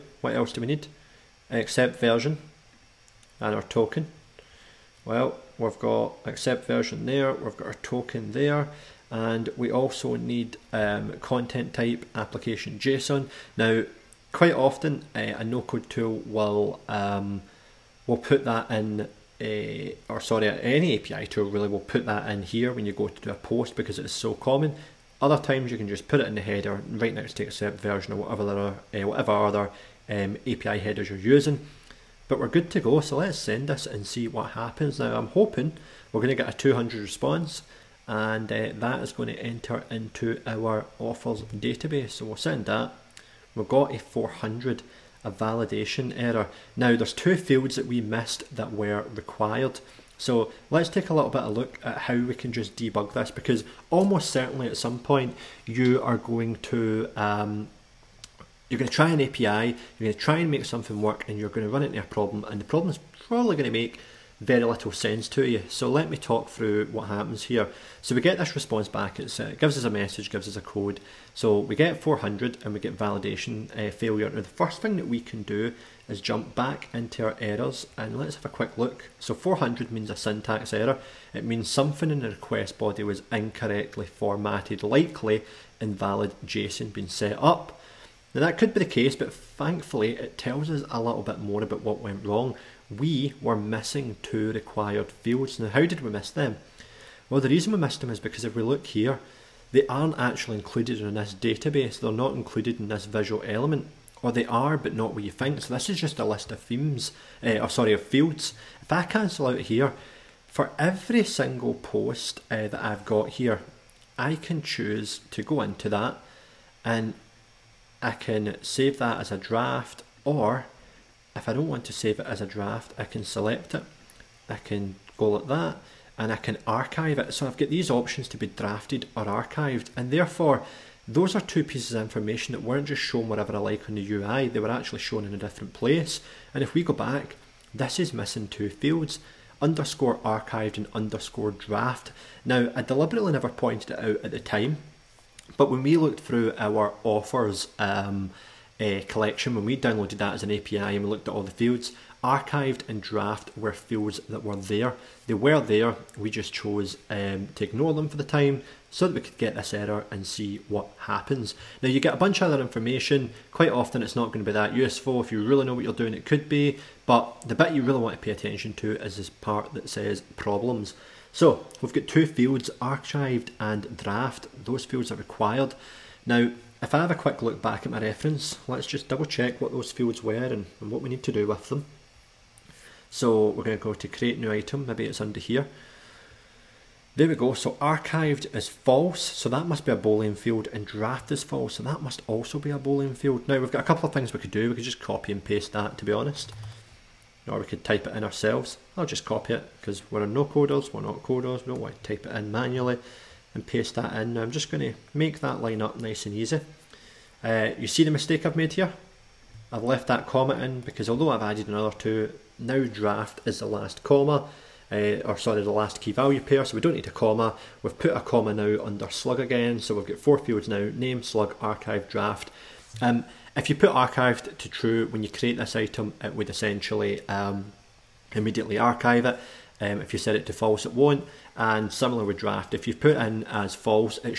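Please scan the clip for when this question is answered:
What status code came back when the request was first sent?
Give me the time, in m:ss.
0:43.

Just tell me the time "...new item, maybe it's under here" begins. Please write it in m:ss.
3:04.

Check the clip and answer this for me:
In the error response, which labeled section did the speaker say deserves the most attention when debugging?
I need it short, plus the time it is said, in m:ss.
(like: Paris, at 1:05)
problems, at 2:50.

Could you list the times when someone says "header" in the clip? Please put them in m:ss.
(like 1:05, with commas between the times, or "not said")
0:26, 0:30.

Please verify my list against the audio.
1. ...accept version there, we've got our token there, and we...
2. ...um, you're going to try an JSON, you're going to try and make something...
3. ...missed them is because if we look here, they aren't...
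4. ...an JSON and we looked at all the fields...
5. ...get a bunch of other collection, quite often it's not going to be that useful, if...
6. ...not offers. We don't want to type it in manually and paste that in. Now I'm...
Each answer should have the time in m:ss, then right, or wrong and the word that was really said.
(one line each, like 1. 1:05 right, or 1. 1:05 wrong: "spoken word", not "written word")
1. 0:06 right
2. 0:57 wrong: "API", not "JSON"
3. 1:37 right
4. 2:30 wrong: "API", not "JSON"
5. 2:41 wrong: "information", not "collection"
6. 3:21 wrong: "coders", not "offers".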